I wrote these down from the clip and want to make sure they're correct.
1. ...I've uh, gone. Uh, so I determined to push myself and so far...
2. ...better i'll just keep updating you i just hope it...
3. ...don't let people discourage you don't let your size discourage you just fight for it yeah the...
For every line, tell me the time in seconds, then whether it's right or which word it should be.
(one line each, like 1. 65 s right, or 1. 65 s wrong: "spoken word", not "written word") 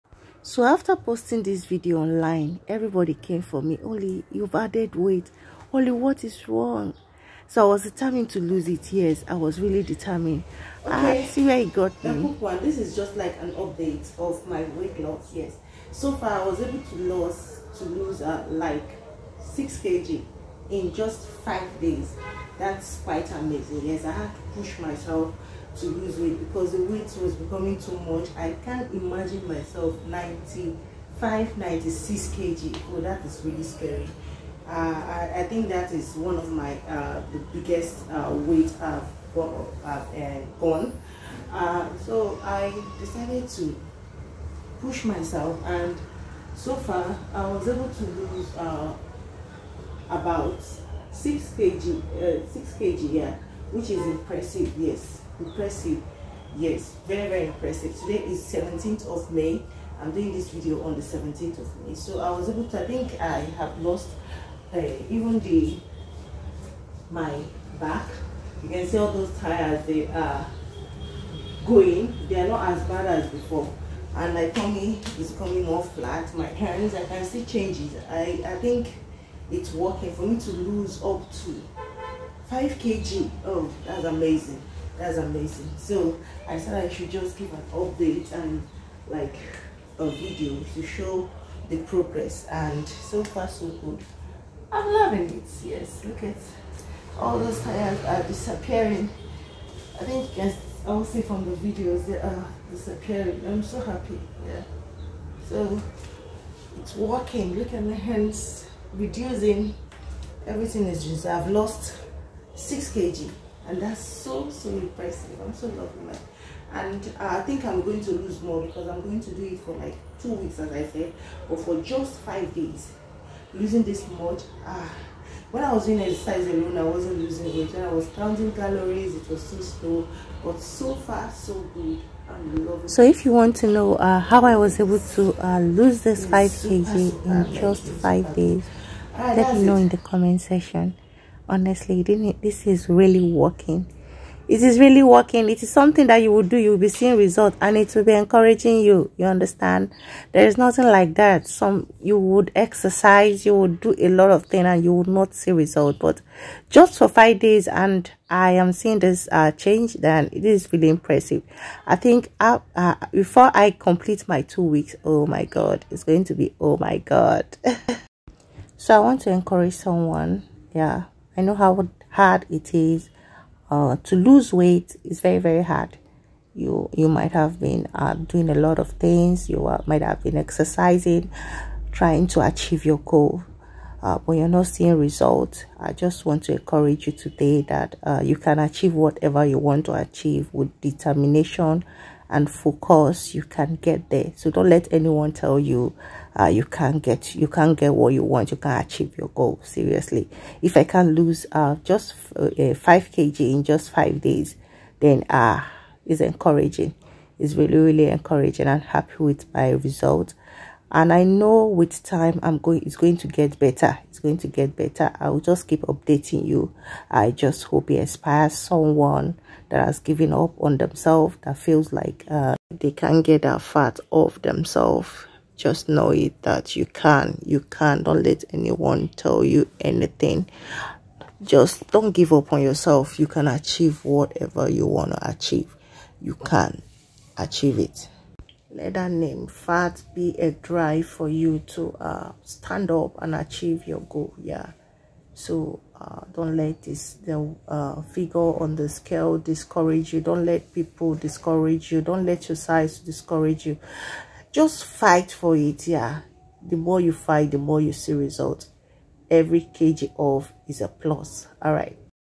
1. 39 s wrong: "decided", not "determined"
2. 214 s right
3. 250 s right.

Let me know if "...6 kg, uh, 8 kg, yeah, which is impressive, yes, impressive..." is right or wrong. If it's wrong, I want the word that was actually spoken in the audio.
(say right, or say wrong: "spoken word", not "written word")
wrong: "6", not "8".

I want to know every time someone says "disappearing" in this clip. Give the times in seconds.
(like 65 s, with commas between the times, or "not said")
98 s, 102 s.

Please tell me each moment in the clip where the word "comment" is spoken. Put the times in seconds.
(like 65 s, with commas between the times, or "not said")
139 s.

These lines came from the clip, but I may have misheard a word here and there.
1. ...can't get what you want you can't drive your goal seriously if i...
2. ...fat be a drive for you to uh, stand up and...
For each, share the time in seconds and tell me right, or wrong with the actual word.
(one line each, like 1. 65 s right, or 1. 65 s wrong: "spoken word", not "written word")
1. 197 s wrong: "achieve", not "drive"
2. 239 s right.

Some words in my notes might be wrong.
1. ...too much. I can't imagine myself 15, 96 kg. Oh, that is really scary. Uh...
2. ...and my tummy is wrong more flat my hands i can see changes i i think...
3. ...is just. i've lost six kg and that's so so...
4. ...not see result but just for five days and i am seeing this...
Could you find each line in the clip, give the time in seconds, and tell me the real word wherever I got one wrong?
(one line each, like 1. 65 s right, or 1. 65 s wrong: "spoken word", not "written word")
1. 27 s wrong: "95", not "15"
2. 74 s wrong: "coming", not "wrong"
3. 110 s right
4. 155 s right.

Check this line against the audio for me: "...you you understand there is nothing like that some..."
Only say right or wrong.
right.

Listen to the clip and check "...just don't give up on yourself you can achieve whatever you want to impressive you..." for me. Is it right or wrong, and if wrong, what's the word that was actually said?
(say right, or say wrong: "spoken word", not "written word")
wrong: "achieve", not "impressive".